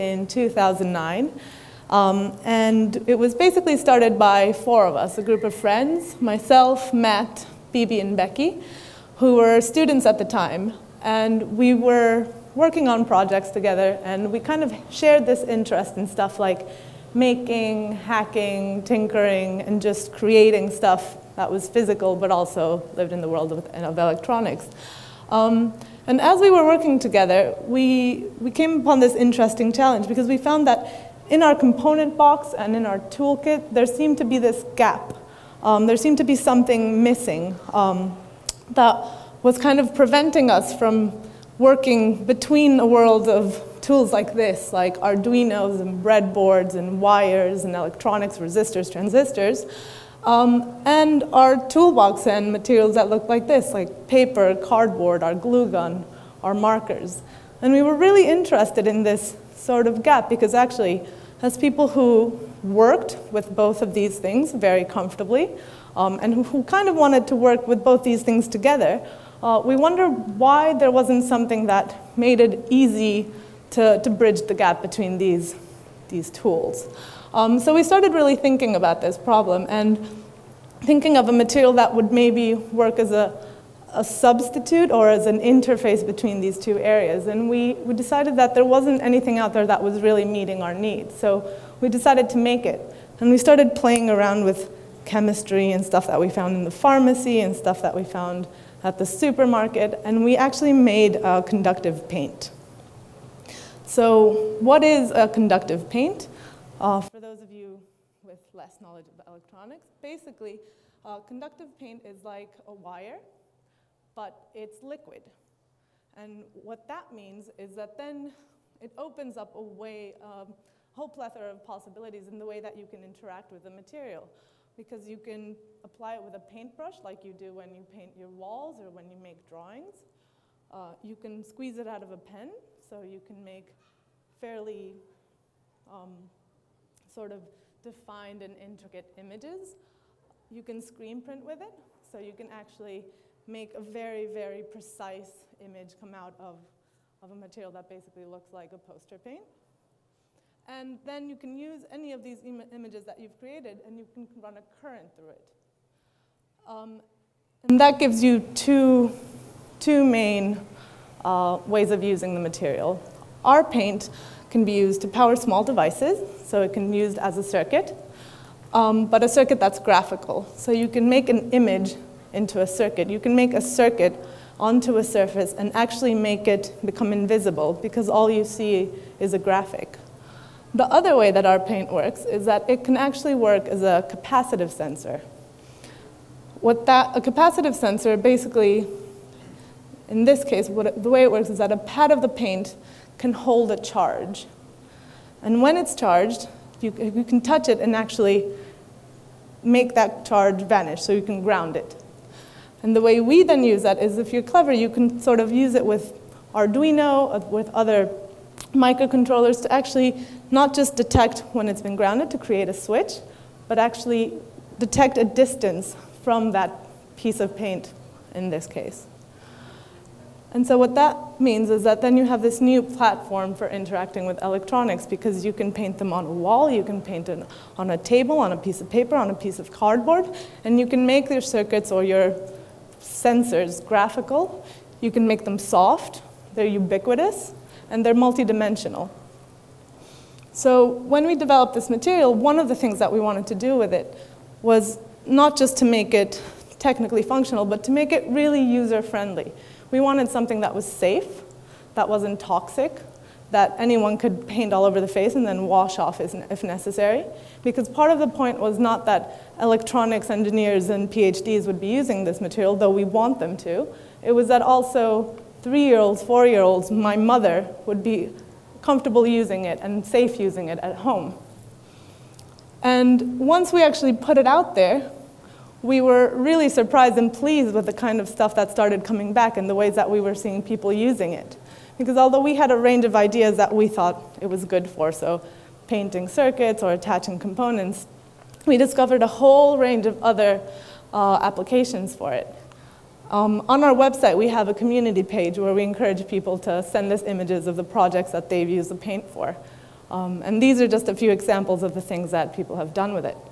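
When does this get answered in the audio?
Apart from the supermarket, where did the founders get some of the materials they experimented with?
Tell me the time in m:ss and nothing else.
1:36.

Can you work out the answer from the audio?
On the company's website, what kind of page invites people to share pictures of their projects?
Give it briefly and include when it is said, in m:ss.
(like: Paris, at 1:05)
Community page, at 4:54.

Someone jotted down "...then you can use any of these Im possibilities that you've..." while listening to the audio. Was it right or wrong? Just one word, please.
wrong.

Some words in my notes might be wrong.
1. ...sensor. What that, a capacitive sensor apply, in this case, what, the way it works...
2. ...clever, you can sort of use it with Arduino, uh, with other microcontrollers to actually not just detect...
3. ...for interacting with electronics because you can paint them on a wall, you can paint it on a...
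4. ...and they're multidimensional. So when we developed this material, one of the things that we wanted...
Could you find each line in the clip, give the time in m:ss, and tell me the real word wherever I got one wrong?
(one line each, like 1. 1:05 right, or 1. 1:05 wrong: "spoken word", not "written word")
1. 3:04 wrong: "basically", not "apply"
2. 3:24 right
3. 3:43 right
4. 3:57 right.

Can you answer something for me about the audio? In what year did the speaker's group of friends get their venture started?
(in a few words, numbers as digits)
2009.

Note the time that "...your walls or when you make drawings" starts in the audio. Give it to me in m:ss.
2:08.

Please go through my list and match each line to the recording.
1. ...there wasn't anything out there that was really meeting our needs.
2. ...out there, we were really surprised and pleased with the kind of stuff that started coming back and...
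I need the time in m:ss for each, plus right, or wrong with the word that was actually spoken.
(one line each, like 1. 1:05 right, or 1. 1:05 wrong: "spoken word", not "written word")
1. 1:28 right
2. 4:34 right.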